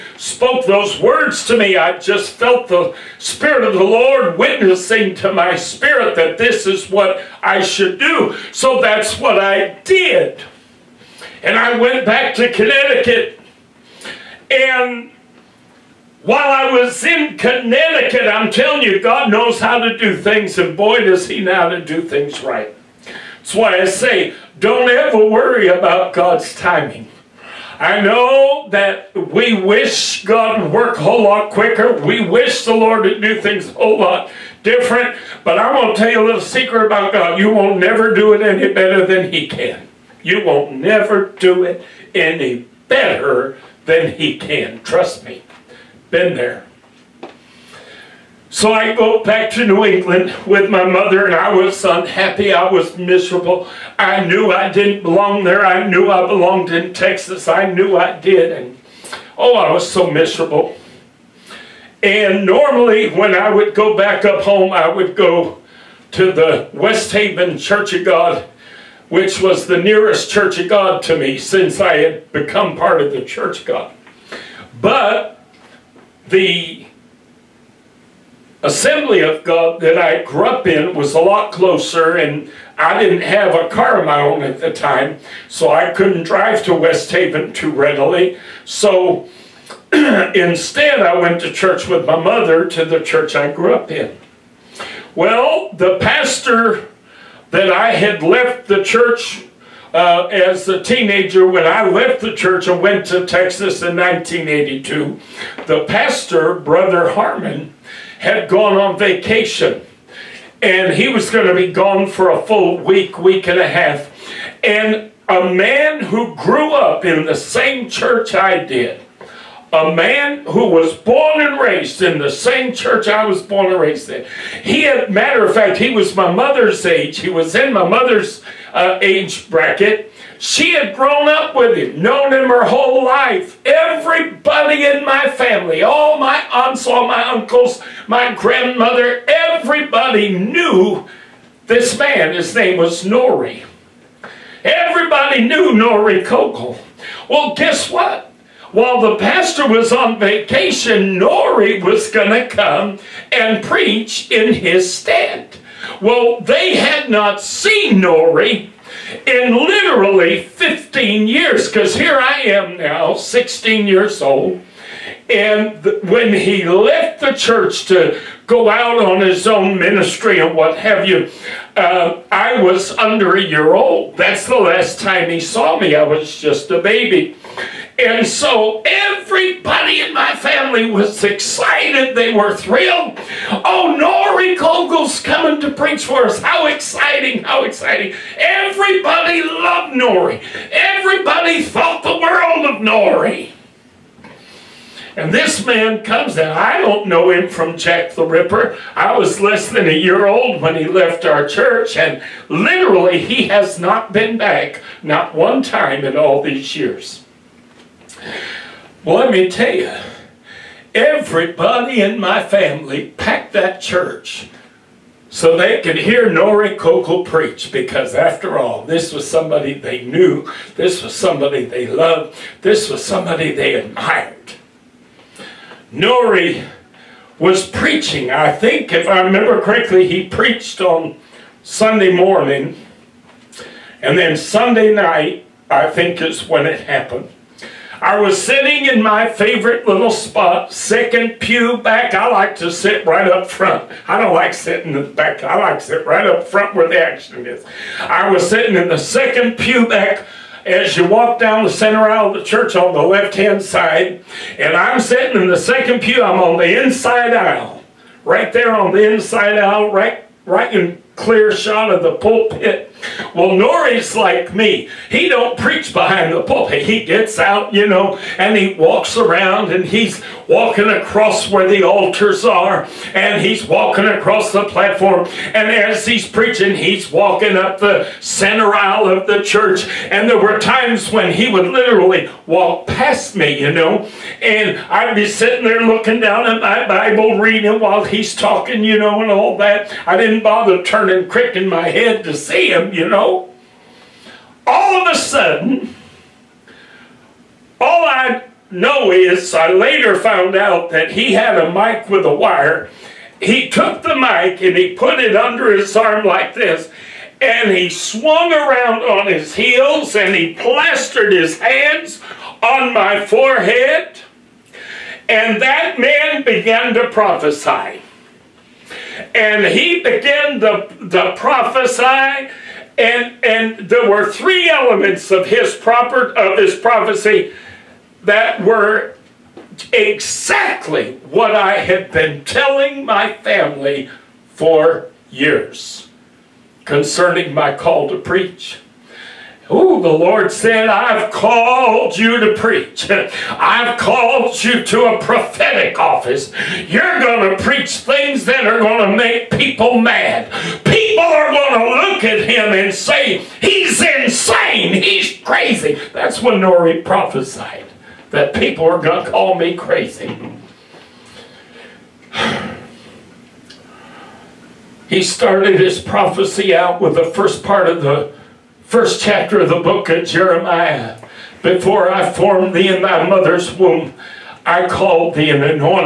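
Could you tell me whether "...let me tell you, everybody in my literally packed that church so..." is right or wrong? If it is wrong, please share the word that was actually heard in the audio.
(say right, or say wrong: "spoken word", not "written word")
wrong: "family", not "literally".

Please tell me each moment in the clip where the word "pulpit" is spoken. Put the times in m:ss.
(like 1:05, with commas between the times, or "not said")
4:22, 4:26.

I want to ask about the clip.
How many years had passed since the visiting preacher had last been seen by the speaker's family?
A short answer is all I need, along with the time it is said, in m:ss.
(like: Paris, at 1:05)
15, at 2:40.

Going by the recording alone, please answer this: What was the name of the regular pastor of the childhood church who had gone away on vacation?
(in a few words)
Brother Harmon.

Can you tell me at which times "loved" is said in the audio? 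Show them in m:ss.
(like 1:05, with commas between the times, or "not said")
3:09, 3:41.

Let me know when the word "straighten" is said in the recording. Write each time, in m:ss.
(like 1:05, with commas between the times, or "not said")
not said.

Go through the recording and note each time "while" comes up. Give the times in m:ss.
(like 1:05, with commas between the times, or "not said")
0:16, 2:28, 4:47.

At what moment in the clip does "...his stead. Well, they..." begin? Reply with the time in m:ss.
2:34.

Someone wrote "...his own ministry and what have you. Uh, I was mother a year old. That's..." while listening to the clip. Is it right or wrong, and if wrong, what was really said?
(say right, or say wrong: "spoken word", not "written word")
wrong: "under", not "mother".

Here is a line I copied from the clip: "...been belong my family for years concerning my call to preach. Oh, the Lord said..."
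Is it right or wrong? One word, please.
wrong.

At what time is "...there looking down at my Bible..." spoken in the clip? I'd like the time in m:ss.
4:45.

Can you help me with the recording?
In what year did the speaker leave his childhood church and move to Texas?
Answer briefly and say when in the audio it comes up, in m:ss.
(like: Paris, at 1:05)
1982, at 1:43.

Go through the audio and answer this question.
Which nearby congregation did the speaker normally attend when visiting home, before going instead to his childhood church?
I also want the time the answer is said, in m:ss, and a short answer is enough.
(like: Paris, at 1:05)
West Haven Church of God, at 1:06.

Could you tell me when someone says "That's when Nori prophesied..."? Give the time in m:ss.
5:56.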